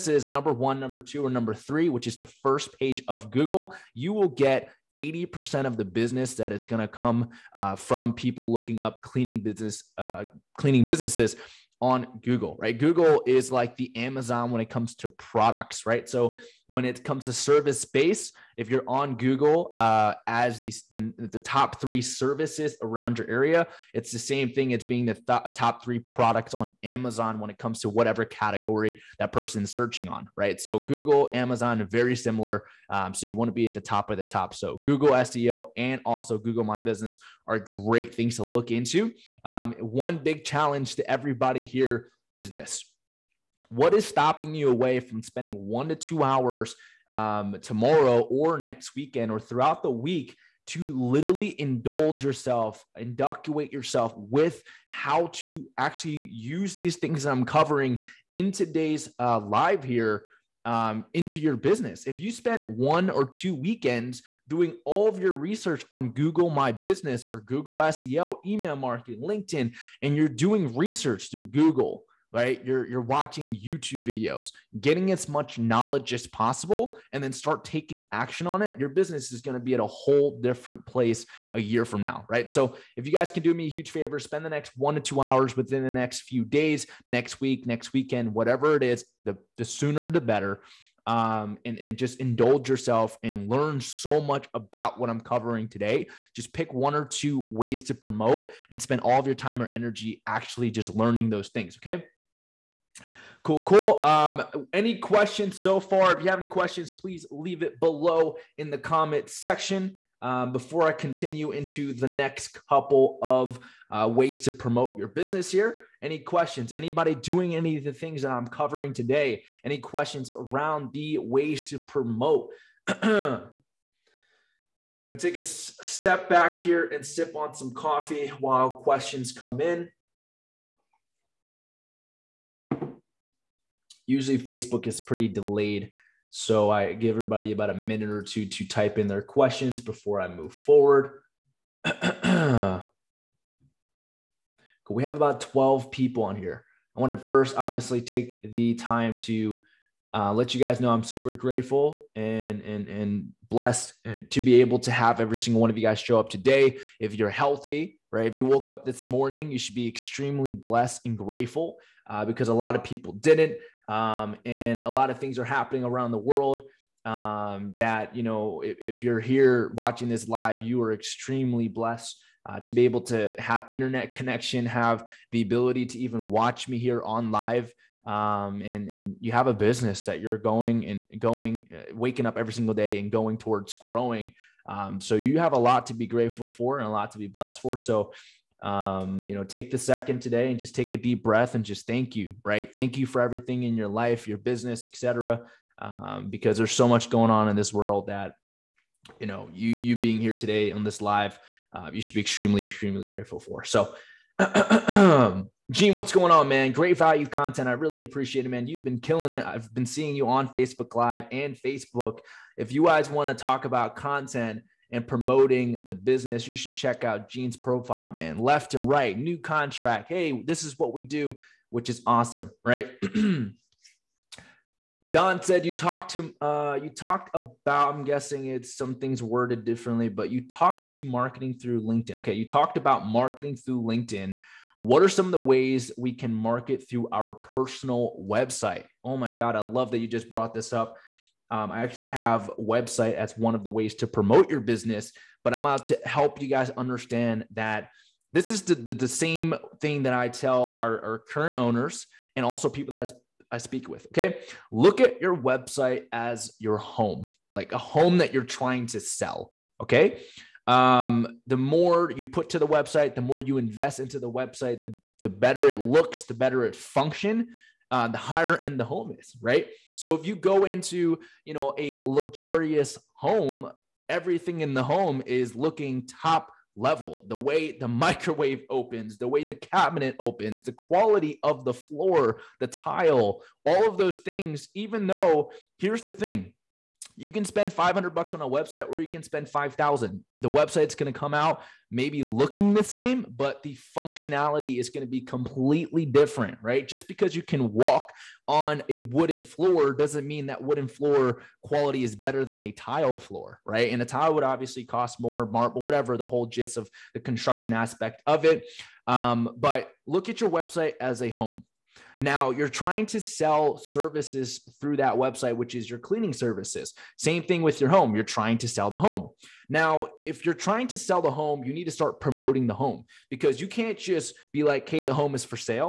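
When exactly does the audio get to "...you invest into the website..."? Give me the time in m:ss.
4:23.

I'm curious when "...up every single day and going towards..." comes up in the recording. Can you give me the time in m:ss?
3:02.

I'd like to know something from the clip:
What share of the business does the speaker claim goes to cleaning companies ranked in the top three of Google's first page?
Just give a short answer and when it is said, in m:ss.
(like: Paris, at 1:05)
80%, at 0:04.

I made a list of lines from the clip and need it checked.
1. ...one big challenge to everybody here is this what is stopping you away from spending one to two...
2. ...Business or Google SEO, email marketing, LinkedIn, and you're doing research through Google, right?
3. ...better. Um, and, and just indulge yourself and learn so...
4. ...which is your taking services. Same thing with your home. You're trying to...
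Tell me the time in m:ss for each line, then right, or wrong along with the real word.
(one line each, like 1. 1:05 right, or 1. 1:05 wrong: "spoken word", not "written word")
1. 0:39 right
2. 1:06 right
3. 1:30 right
4. 5:15 wrong: "cleaning", not "taking".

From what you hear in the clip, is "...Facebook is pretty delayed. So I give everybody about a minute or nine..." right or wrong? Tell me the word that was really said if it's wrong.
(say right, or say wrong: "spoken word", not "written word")
wrong: "two", not "nine".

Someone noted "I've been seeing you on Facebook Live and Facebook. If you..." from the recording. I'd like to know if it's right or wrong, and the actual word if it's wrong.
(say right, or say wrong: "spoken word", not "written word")
right.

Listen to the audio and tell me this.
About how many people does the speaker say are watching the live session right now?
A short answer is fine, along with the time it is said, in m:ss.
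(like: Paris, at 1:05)
12, at 2:25.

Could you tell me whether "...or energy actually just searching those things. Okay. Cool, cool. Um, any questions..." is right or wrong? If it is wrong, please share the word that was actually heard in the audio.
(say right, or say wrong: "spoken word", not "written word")
wrong: "learning", not "searching".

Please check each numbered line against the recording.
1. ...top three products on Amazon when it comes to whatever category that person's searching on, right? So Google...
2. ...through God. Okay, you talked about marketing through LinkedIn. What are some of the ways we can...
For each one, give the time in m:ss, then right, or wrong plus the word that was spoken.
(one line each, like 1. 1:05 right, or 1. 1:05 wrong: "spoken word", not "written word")
1. 0:25 right
2. 3:51 wrong: "LinkedIn", not "God".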